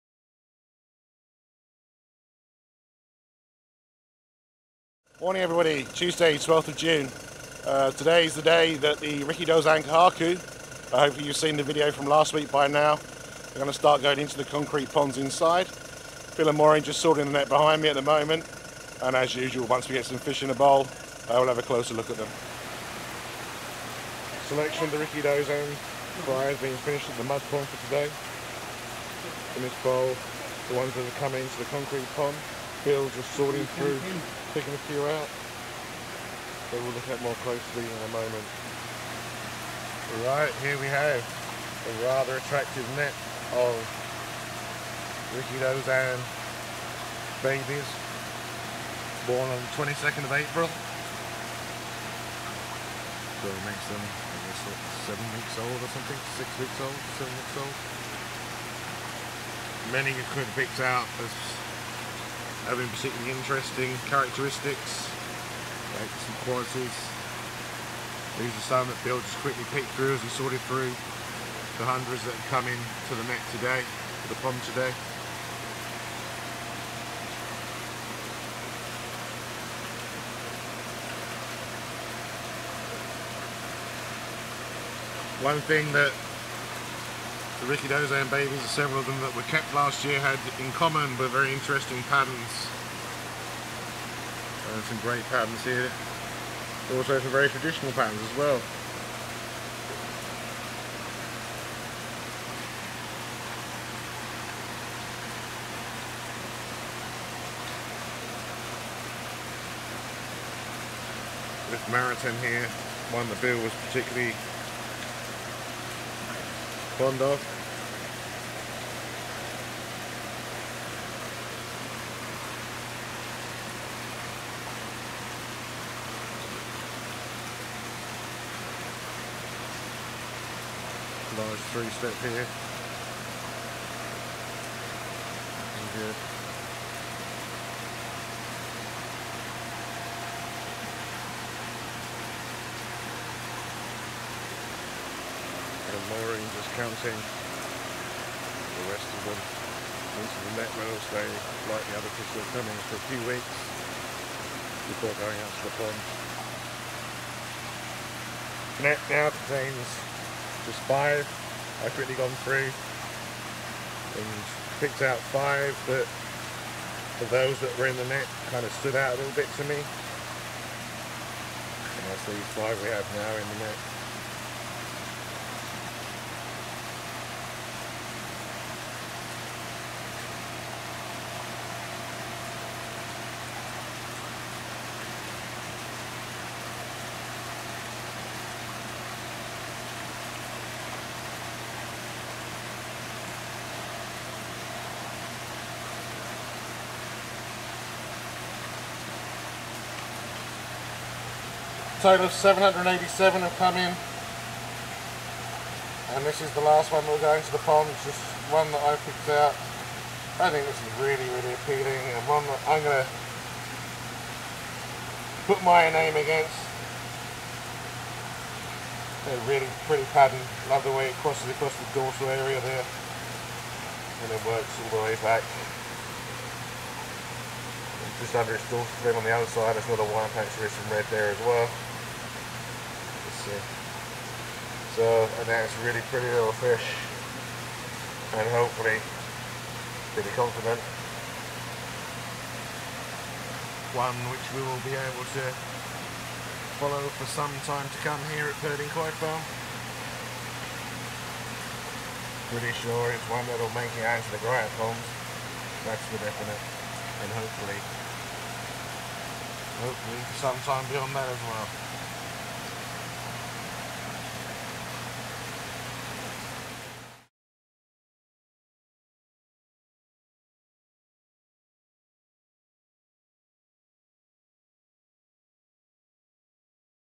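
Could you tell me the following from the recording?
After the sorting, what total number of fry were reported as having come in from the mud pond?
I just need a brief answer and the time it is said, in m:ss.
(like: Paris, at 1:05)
787, at 3:22.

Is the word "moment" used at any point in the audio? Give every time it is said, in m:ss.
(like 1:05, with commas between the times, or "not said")
0:18, 0:38.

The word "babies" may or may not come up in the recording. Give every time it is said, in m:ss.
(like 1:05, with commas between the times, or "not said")
0:47, 1:28.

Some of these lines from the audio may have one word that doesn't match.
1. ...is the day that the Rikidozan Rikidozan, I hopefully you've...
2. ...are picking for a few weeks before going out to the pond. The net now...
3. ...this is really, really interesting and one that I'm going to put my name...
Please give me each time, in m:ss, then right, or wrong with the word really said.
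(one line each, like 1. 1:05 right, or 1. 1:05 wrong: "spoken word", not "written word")
1. 0:08 wrong: "Kohaku", not "Rikidozan"
2. 2:32 wrong: "coming", not "picking"
3. 3:30 wrong: "appealing", not "interesting".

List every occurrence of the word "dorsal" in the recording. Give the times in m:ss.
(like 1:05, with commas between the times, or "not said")
3:41, 3:48.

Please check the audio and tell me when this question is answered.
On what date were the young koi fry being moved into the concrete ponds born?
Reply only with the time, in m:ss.
0:49.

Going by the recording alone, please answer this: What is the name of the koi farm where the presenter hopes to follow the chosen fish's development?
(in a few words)
Purdin Koi Farm.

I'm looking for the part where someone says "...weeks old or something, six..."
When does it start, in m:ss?
0:55.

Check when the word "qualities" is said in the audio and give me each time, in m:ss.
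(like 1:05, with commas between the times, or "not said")
1:06.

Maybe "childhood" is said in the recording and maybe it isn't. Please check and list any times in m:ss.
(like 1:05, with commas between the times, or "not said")
not said.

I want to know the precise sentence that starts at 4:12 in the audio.
Pretty sure it's one that'll make it out to the Griot Holmes.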